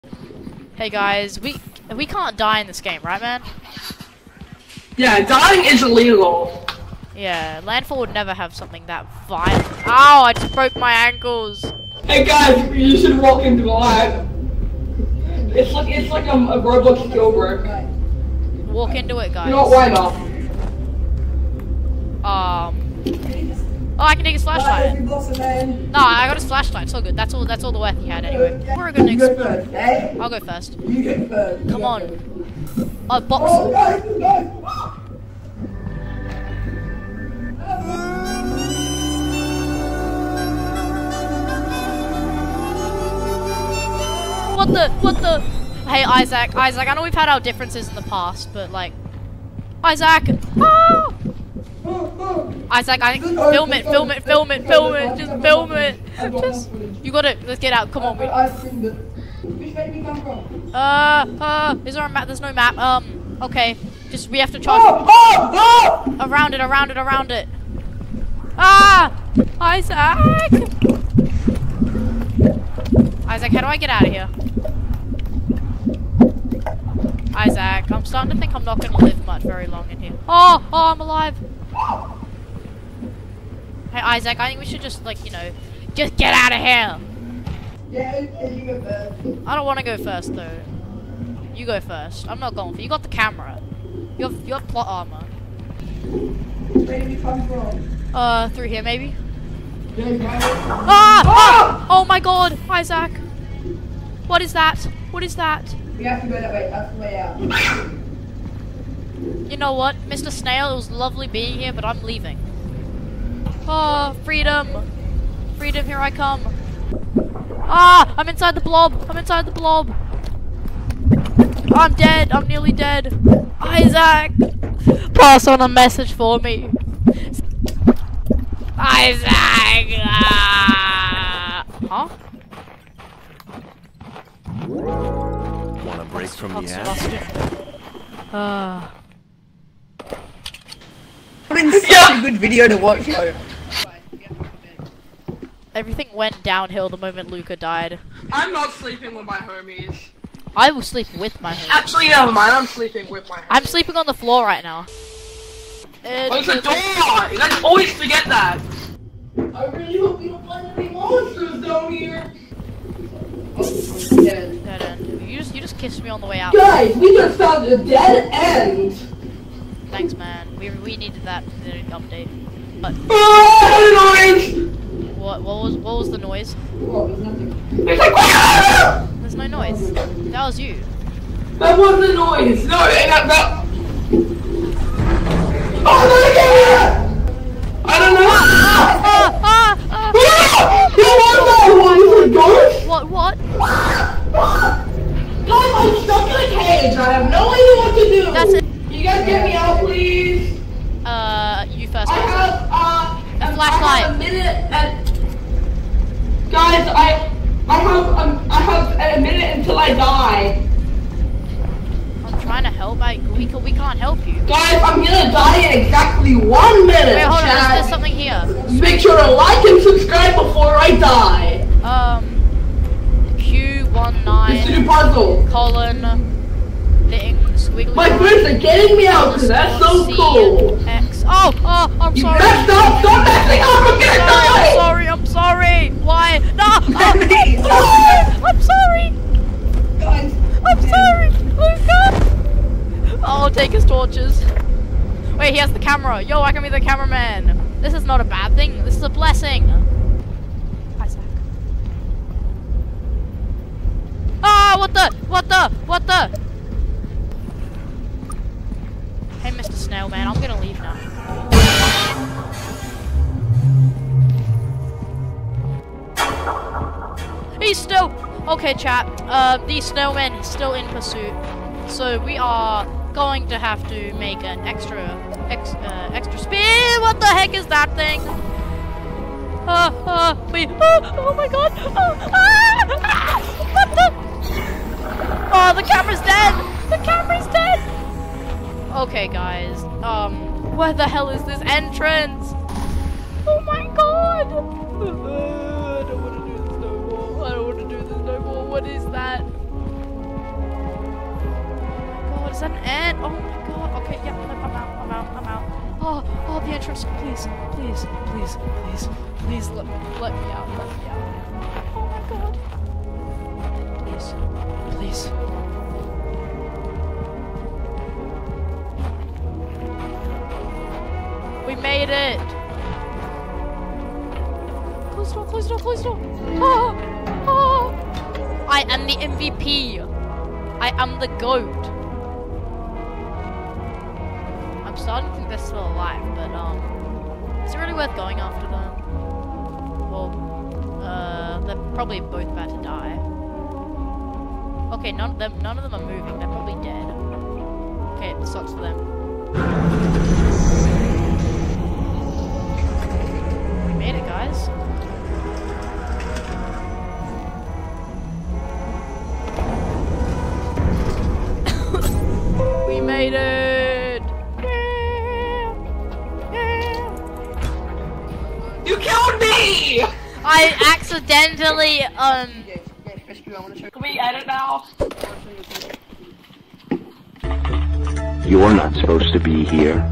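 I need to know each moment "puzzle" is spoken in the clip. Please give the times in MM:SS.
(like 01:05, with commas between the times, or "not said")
03:44.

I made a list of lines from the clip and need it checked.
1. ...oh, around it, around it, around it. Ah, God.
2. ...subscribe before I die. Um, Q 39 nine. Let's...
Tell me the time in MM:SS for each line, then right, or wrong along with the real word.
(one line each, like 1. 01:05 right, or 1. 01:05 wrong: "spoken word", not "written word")
1. 01:06 wrong: "Isaac", not "God"
2. 03:39 wrong: "19", not "39".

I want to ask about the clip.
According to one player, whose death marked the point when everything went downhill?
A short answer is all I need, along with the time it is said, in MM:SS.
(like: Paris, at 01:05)
Luca, at 02:27.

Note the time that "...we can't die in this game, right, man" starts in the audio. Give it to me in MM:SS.
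00:01.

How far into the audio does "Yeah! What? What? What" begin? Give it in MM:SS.
03:11.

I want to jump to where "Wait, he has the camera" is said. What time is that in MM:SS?
04:05.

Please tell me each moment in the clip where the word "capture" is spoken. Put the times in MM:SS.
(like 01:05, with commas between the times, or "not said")
not said.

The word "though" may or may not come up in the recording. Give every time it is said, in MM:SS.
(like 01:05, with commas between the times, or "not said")
01:30, 02:23.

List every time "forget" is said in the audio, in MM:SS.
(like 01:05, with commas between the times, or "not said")
02:37.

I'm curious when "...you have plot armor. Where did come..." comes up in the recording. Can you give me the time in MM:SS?
01:34.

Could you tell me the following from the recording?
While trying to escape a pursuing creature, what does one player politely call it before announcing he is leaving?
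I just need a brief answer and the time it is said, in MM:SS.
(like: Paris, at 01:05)
Mr. Snail, at 01:50.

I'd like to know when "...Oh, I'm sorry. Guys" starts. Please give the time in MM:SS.
03:57.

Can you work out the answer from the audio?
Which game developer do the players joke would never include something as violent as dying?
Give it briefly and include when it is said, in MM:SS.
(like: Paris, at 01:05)
Landfall, at 00:07.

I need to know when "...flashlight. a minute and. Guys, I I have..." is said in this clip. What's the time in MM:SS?
03:23.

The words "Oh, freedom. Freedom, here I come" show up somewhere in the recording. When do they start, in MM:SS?
01:53.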